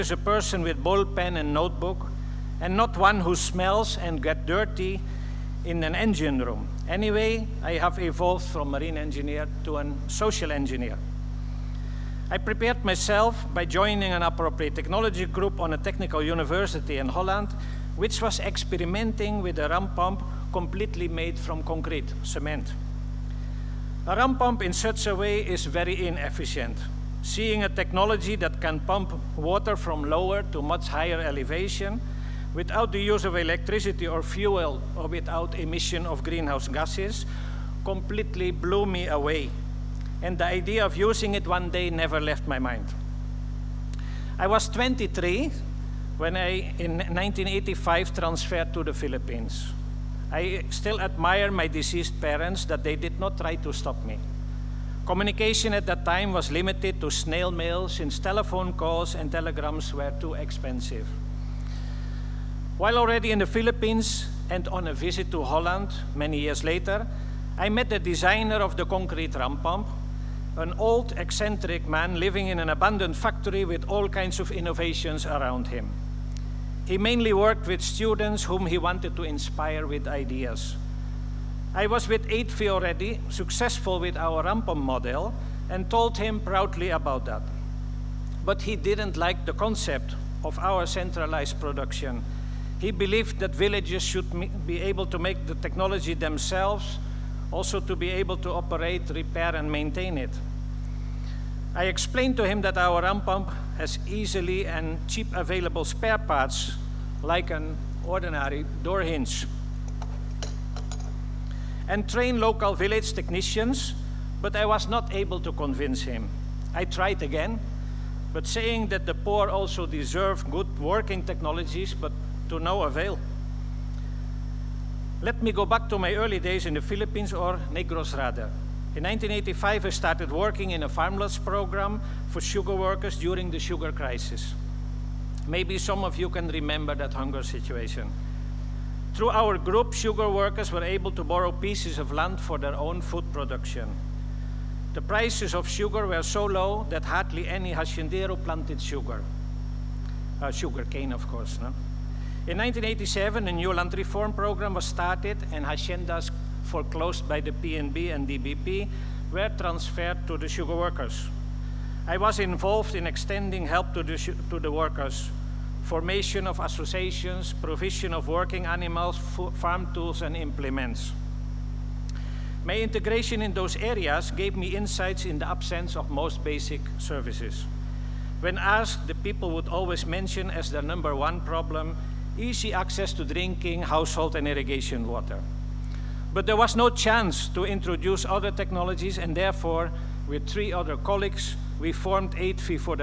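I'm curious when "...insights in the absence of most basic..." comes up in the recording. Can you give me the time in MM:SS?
02:54.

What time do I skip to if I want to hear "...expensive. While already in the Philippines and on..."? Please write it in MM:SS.
01:00.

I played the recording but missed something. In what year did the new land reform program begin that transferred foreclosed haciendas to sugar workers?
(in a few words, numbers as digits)
1987.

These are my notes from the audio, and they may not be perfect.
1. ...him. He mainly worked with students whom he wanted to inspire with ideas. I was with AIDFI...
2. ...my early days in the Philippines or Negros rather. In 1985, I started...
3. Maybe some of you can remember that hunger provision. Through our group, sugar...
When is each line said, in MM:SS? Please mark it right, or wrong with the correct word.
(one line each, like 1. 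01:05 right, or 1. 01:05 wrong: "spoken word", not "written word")
1. 01:15 right
2. 02:05 right
3. 02:15 wrong: "situation", not "provision".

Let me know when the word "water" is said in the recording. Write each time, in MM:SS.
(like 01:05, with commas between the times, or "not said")
00:29, 03:05.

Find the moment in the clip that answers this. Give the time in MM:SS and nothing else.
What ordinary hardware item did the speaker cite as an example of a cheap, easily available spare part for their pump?
01:48.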